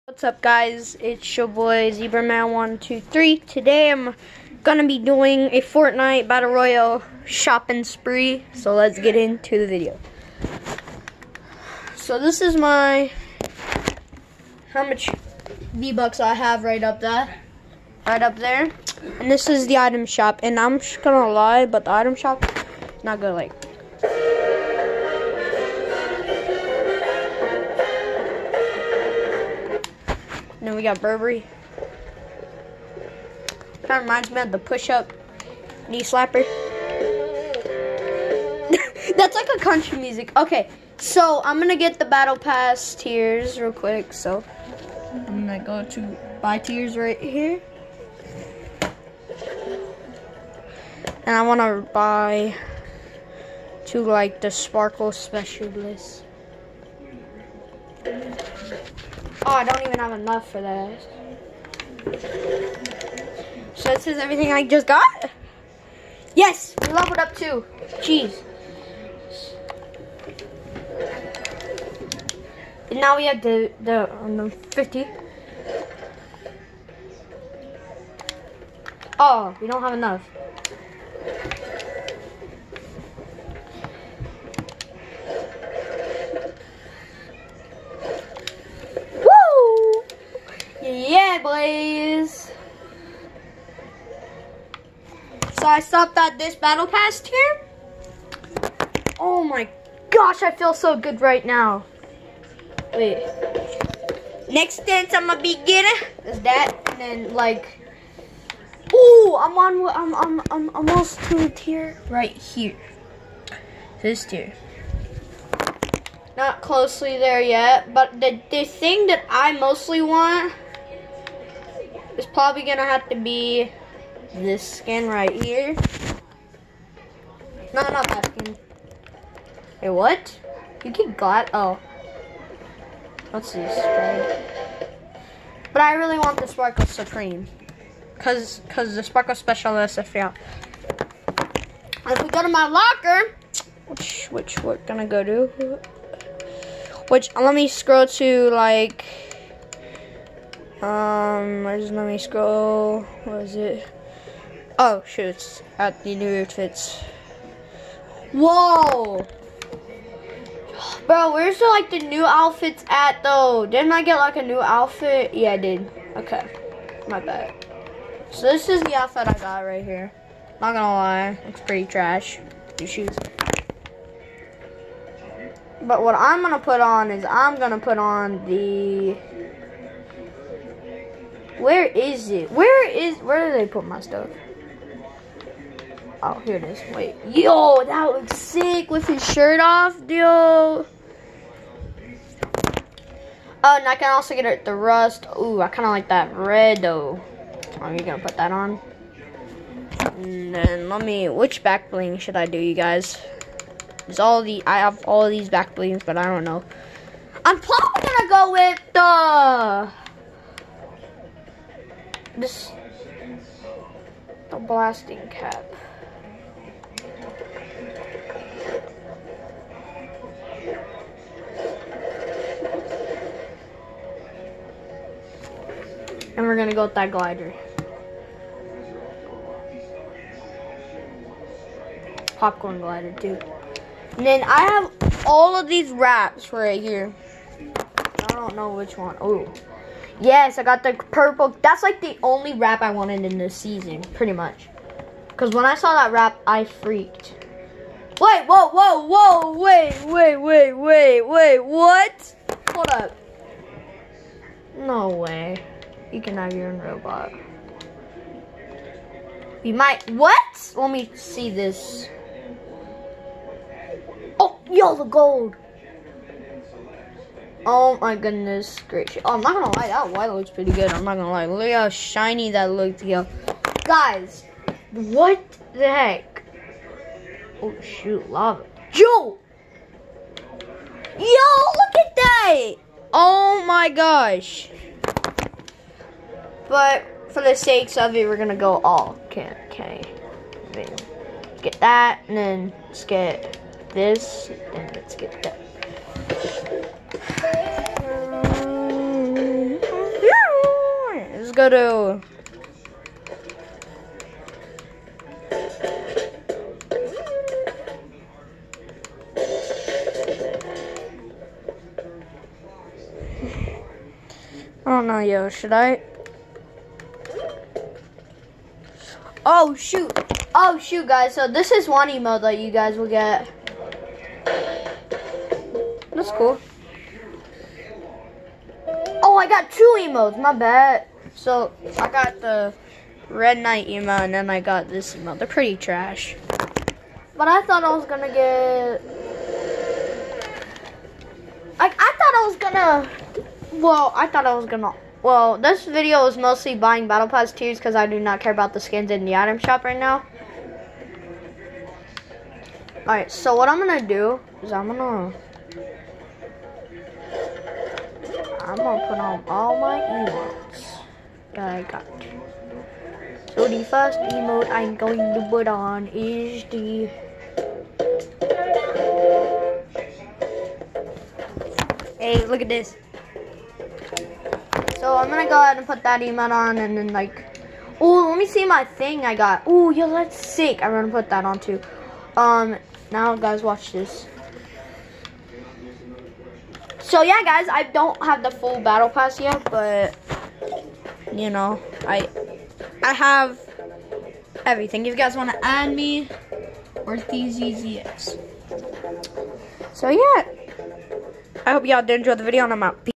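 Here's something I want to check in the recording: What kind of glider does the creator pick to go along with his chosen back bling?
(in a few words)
Popcorn glider.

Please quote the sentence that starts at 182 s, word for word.
Where is, where did they put my stuff?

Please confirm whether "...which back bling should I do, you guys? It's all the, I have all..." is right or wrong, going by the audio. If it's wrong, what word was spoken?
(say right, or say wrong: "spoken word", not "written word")
right.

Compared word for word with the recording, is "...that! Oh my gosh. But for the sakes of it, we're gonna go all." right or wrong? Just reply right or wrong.
right.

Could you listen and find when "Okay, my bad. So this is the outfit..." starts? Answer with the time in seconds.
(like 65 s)
166 s.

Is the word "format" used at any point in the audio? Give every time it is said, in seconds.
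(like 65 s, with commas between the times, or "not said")
not said.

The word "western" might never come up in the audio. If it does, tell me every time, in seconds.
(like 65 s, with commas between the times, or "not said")
not said.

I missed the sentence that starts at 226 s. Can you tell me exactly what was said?
And we're gonna go with that glider.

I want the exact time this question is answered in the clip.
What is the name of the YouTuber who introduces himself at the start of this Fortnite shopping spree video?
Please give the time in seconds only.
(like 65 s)
1 s.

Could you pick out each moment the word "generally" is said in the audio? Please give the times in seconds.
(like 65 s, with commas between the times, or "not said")
not said.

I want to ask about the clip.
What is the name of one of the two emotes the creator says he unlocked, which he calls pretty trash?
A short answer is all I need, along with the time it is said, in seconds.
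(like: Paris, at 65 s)
Red Knight, at 333 s.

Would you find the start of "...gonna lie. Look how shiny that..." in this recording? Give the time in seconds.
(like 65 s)
271 s.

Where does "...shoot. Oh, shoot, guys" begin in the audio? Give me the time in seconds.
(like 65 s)
319 s.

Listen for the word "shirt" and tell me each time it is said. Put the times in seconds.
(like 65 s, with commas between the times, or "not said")
189 s.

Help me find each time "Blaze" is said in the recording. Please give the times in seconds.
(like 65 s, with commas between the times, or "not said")
91 s.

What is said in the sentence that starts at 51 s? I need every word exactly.
And I wanna buy to like the Sparkle Specialist.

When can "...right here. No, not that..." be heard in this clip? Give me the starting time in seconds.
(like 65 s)
125 s.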